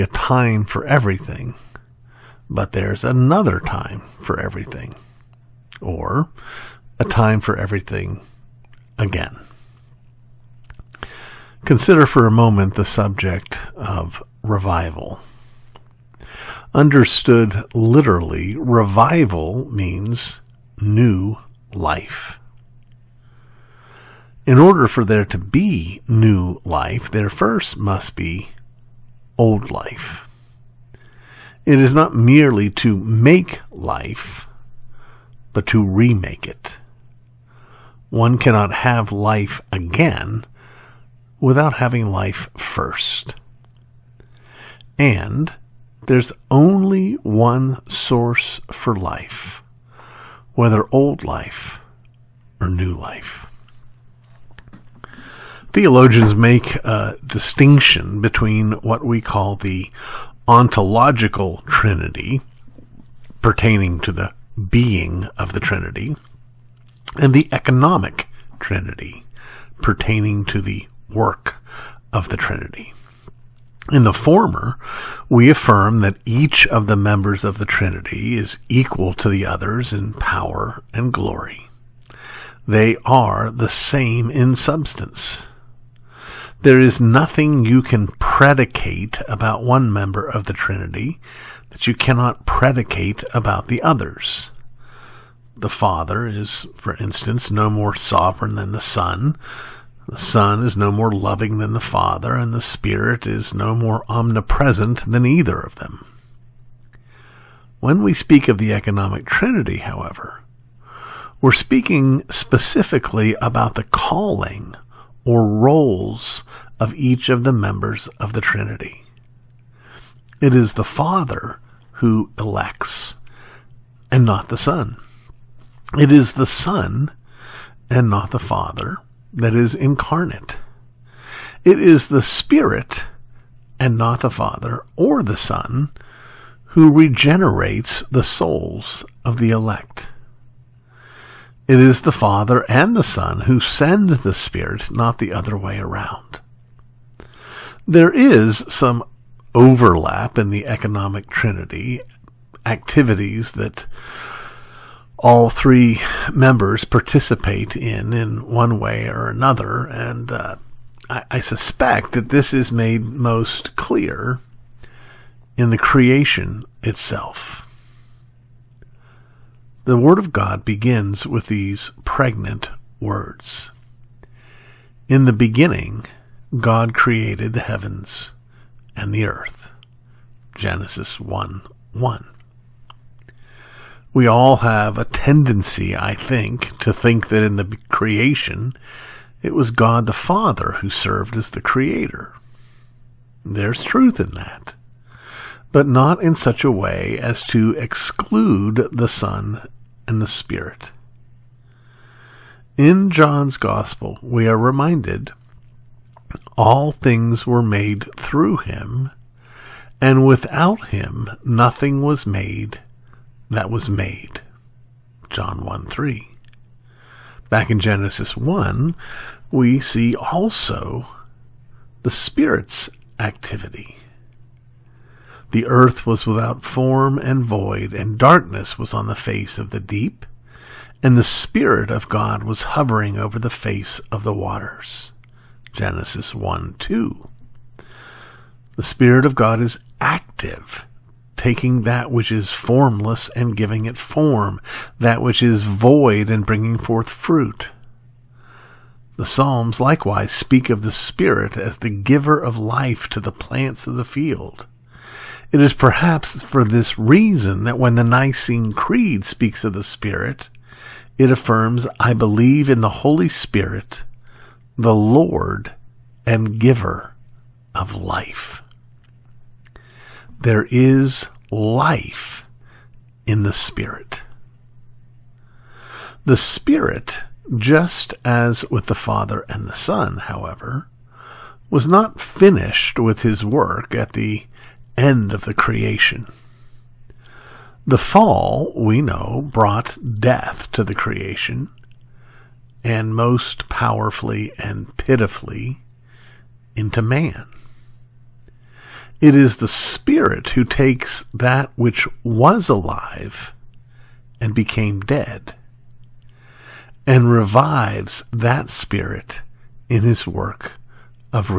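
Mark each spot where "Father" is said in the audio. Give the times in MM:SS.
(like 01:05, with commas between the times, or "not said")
01:35, 01:41, 02:00, 02:08, 02:14, 02:22, 03:10, 04:38.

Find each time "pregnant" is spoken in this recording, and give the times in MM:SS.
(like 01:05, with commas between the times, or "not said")
02:52.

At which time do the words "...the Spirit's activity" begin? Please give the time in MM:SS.
03:42.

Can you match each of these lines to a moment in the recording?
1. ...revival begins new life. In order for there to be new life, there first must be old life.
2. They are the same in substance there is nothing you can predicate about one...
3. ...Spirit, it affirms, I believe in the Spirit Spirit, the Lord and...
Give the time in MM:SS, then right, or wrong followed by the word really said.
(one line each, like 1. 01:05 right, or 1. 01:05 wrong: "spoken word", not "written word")
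1. 00:18 wrong: "means", not "begins"
2. 01:22 right
3. 04:19 wrong: "Holy", not "Spirit".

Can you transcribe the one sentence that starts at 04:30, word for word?
There is life in the Spirit.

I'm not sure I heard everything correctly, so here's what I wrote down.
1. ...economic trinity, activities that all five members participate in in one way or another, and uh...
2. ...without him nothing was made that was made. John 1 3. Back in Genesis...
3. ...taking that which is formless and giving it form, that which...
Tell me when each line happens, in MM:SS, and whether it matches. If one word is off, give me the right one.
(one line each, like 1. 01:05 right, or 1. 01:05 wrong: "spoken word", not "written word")
1. 02:30 wrong: "three", not "five"
2. 03:30 right
3. 04:01 right.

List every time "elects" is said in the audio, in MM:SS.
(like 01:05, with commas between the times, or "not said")
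02:02, 02:19.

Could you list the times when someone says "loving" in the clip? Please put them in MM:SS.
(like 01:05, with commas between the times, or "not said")
01:41.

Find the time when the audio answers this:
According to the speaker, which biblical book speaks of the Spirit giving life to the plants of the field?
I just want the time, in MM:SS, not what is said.
04:09.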